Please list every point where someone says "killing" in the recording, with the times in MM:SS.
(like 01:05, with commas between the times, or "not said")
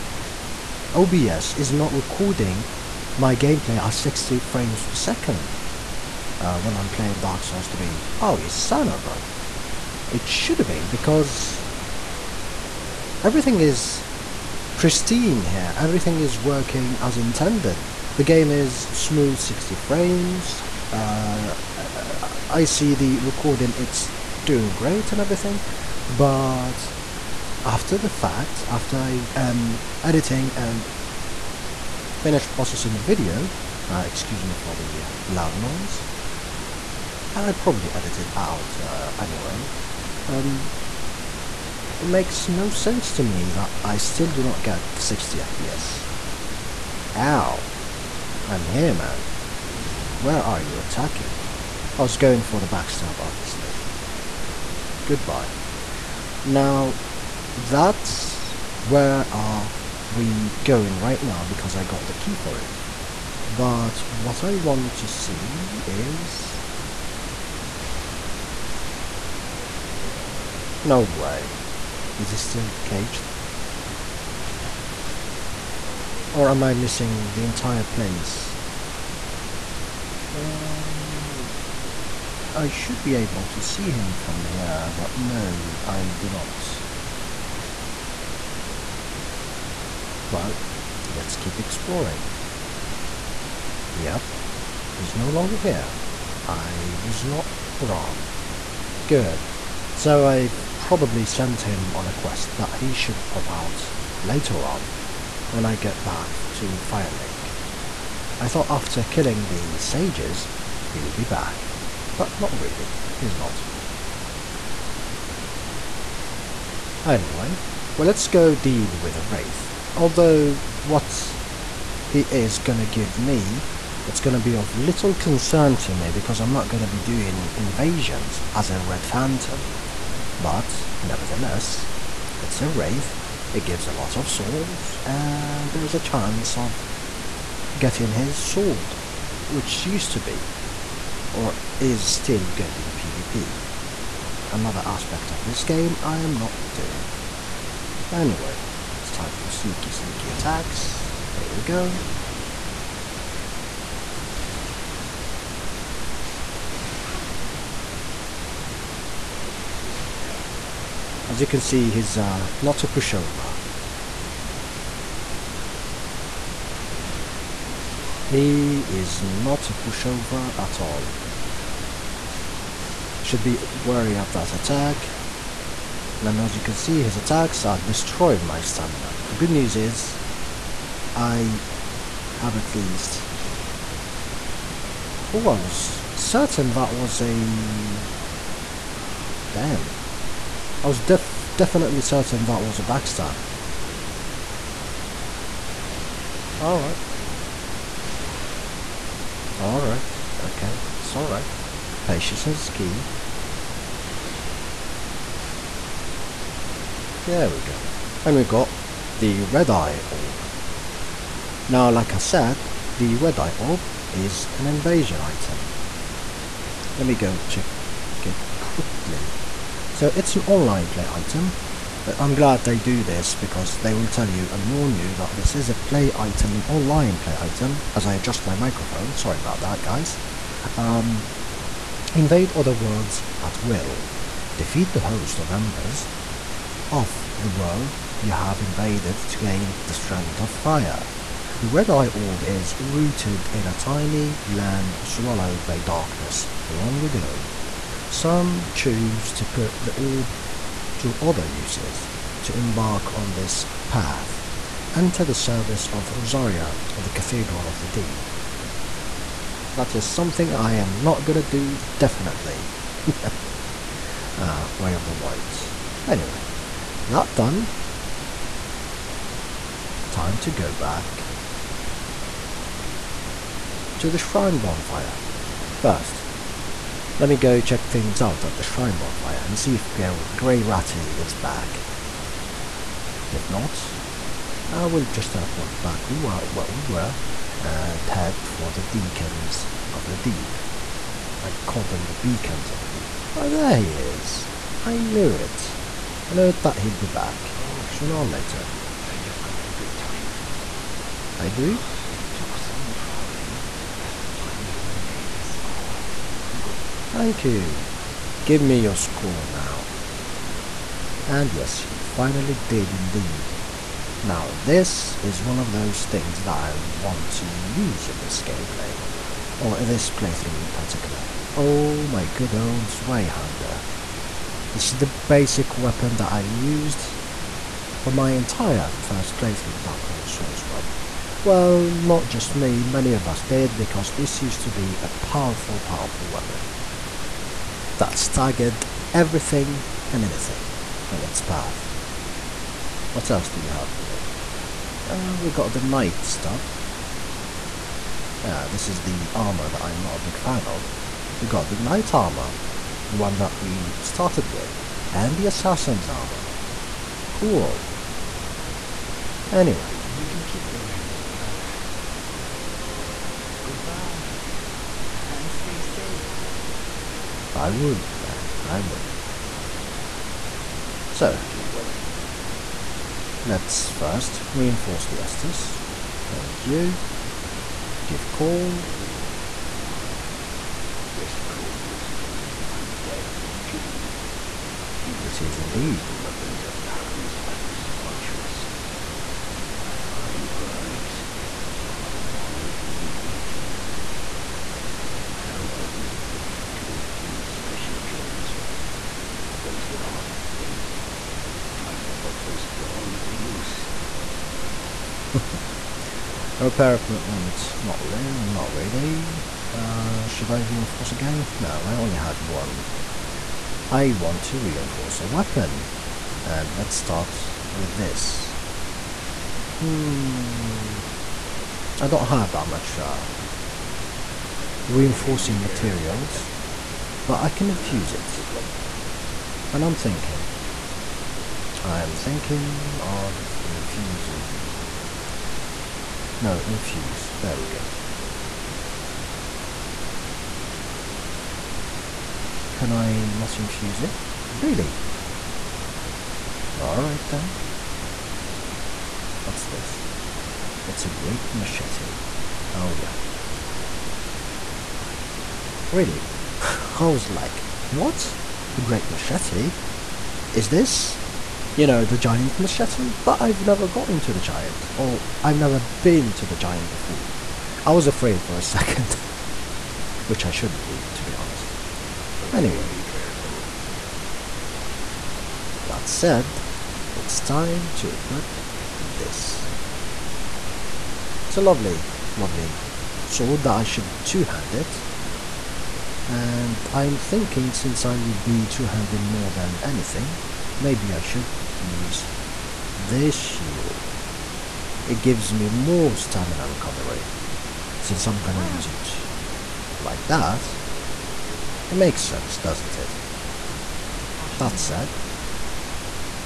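01:49.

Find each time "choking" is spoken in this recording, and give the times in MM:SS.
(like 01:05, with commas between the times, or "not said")
not said.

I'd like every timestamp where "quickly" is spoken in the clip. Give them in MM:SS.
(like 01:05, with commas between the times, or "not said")
03:38.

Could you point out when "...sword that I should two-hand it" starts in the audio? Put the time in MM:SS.
08:03.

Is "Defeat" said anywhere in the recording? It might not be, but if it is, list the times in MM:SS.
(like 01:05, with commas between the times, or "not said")
03:54.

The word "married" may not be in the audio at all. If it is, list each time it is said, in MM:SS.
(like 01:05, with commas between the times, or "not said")
not said.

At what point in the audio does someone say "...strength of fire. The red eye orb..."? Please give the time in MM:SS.
03:59.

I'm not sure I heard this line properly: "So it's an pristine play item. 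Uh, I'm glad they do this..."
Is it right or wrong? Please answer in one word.
wrong.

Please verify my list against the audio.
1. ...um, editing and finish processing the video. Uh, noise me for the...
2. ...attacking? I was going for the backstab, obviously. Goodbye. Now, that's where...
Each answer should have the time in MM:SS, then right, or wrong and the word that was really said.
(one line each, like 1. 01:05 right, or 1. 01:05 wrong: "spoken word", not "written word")
1. 00:29 wrong: "excuse", not "noise"
2. 00:50 right.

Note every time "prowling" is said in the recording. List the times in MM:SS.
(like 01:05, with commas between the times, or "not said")
05:02.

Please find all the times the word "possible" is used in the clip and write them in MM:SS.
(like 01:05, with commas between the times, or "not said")
not said.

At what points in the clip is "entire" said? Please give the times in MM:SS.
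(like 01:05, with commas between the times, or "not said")
01:17, 05:28.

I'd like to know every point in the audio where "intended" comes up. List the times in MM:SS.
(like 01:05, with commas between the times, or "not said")
00:17.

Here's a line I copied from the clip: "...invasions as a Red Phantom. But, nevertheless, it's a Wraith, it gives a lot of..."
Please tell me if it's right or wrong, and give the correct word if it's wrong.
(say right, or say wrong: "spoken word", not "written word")
right.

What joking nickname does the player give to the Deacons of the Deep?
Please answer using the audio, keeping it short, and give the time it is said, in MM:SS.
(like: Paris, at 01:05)
Beacons of the Deep, at 04:52.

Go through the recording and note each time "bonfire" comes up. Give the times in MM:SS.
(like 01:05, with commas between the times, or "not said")
04:34, 04:38.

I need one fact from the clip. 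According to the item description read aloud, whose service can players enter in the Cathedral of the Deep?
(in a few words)
Rosaria.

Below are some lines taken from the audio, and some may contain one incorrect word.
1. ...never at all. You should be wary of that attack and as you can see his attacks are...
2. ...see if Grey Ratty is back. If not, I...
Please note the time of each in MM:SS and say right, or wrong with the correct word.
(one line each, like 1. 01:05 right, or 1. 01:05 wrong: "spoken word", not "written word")
1. 02:49 wrong: "pushover", not "never"
2. 04:39 right.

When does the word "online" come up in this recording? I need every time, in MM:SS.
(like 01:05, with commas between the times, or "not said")
03:40, 03:46.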